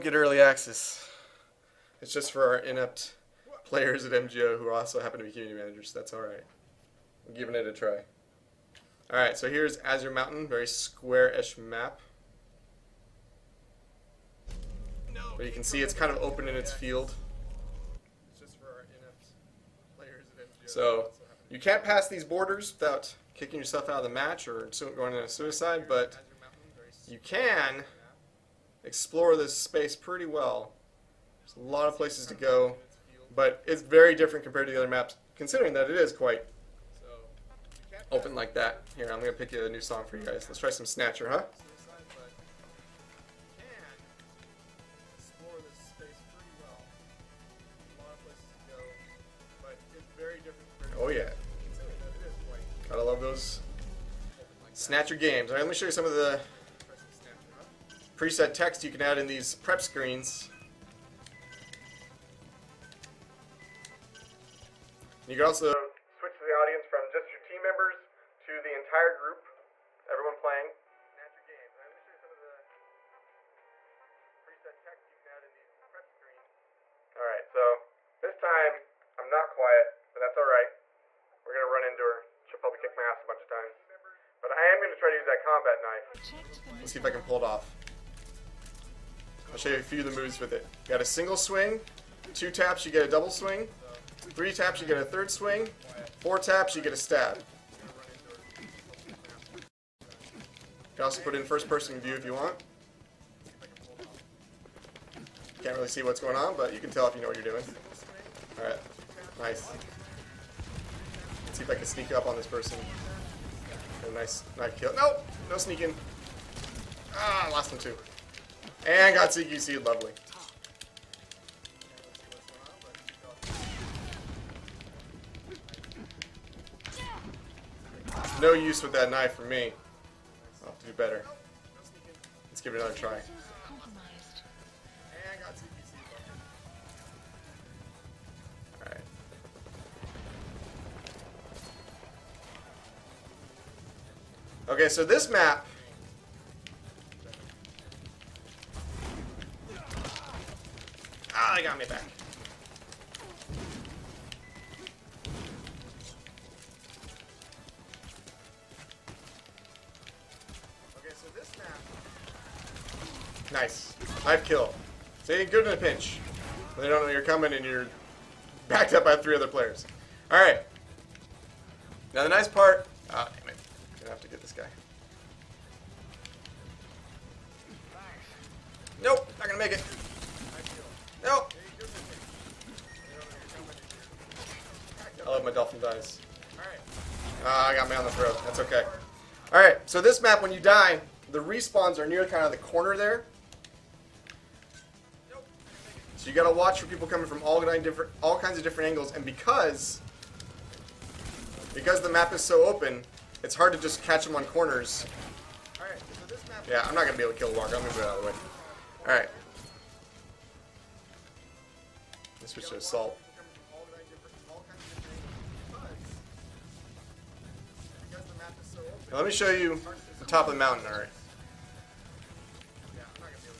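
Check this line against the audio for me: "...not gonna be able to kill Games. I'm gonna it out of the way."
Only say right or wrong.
wrong.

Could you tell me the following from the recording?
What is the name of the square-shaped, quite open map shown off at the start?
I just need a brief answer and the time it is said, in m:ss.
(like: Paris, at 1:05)
Azure Mountain, at 0:09.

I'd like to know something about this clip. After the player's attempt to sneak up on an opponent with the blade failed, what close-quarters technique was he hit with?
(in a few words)
CQC.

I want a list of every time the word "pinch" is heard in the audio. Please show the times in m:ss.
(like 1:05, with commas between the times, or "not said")
2:45.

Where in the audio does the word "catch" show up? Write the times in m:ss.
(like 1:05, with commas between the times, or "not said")
3:24.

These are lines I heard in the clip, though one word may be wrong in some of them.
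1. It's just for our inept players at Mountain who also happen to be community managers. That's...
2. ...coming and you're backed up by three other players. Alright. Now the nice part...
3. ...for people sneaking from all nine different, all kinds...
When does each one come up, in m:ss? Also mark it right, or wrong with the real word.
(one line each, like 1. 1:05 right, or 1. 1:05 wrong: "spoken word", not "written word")
1. 0:02 wrong: "MGO", not "Mountain"
2. 2:47 right
3. 3:16 wrong: "coming", not "sneaking".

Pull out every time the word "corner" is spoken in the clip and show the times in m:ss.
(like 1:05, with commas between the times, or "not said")
3:12, 3:24.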